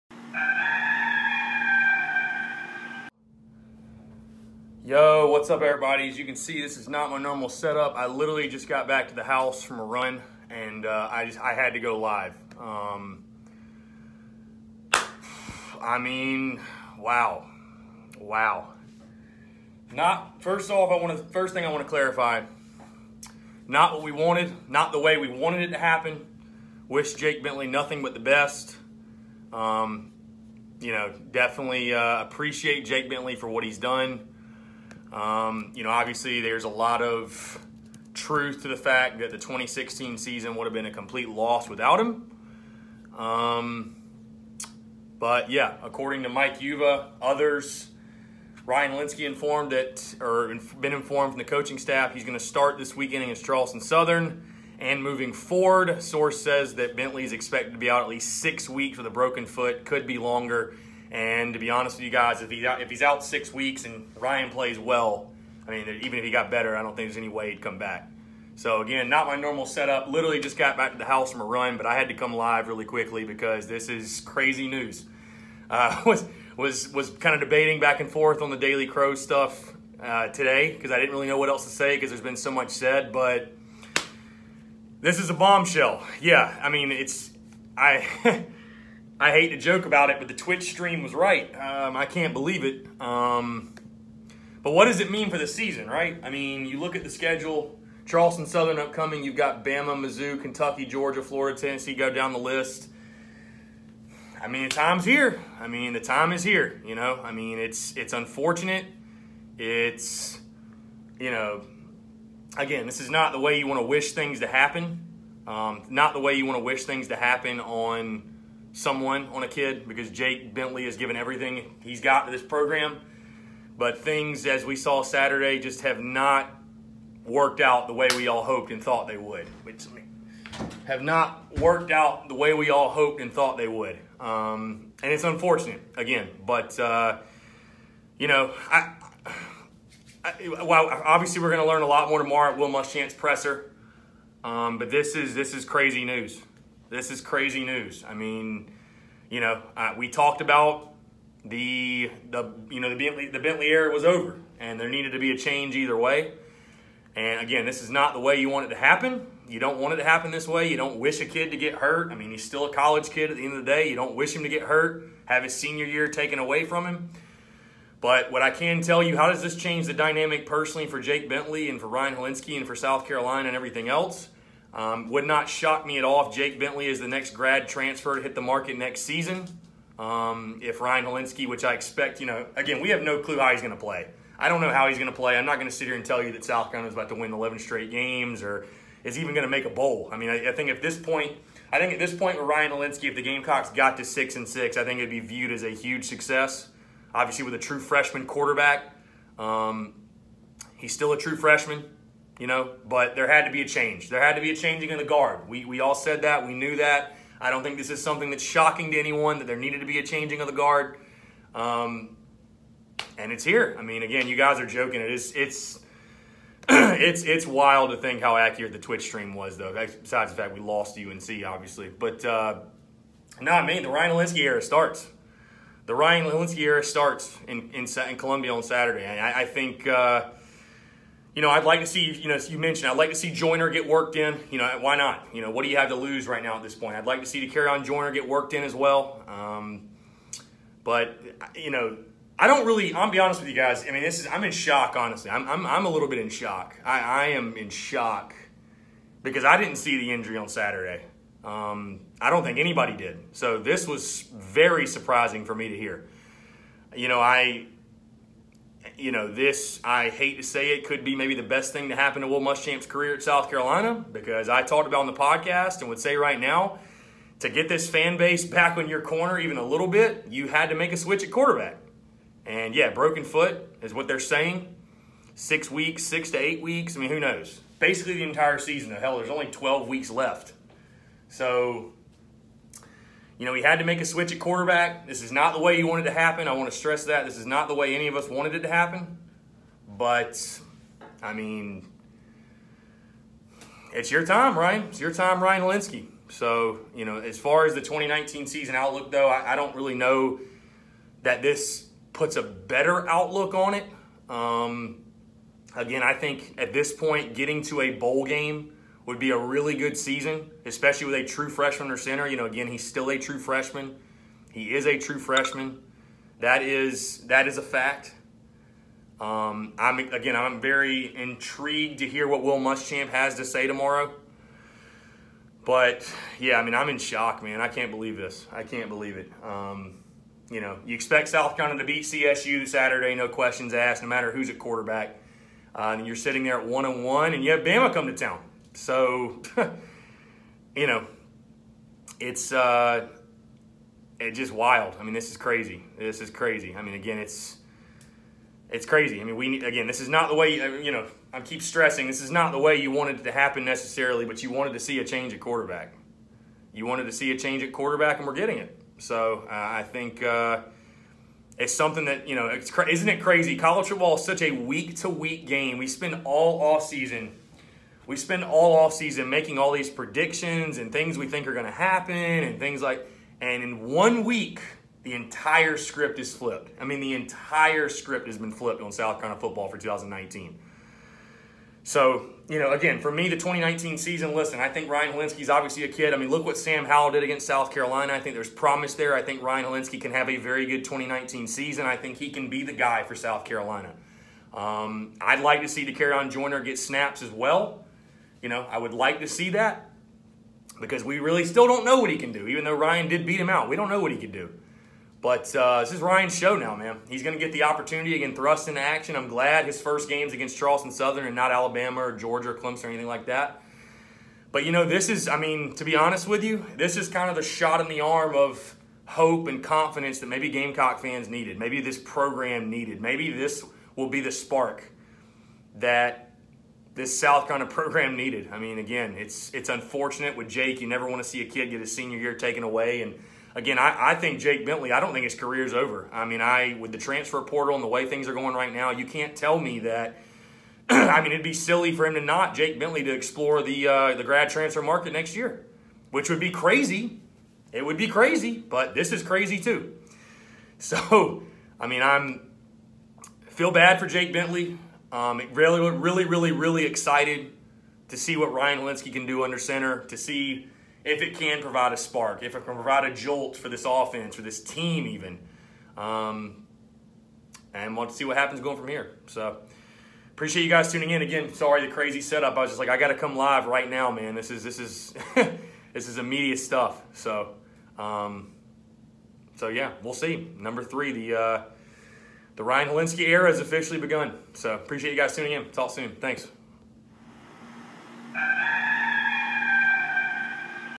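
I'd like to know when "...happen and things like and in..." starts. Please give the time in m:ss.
6:11.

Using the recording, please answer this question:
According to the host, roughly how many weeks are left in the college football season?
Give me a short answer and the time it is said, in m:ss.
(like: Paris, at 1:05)
12, at 4:39.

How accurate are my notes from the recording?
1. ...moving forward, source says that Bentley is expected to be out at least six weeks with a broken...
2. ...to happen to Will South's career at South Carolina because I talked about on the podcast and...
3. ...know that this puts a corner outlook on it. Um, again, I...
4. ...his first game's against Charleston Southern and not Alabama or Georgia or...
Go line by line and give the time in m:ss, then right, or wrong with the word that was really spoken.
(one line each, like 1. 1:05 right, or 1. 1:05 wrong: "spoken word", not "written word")
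1. 0:55 right
2. 4:21 wrong: "Muschamp", not "South"
3. 4:59 wrong: "better", not "corner"
4. 6:49 right.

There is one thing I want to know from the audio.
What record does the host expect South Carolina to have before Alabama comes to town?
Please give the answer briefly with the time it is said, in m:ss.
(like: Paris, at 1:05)
1-1, at 5:36.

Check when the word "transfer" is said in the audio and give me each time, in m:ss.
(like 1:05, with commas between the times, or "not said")
2:57, 7:16, 7:24.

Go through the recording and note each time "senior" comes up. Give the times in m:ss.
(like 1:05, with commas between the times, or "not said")
2:45, 7:11.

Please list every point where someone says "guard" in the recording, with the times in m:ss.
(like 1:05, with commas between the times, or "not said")
3:25, 3:30.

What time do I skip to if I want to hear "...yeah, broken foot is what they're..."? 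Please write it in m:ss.
4:32.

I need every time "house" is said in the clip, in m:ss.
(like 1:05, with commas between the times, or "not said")
0:09, 1:11.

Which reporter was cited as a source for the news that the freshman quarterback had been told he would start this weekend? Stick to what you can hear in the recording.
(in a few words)
Mike Uva.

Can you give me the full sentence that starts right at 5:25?
But yeah, I mean, I'm in shock, man.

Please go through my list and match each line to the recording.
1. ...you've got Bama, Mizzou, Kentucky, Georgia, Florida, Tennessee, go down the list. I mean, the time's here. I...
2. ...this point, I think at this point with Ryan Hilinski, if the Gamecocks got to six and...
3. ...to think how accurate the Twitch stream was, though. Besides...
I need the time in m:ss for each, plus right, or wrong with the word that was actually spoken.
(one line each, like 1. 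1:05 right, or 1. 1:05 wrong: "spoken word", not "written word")
1. 1:39 right
2. 3:10 right
3. 3:37 right.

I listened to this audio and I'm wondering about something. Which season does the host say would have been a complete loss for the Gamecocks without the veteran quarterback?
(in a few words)
2016.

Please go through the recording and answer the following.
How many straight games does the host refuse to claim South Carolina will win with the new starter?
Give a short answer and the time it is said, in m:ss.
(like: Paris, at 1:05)
11, at 3:07.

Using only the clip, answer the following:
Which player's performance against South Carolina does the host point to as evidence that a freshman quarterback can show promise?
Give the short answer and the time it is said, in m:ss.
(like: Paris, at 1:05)
Sam Howell, at 6:26.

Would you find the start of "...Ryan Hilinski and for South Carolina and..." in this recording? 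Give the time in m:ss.
2:51.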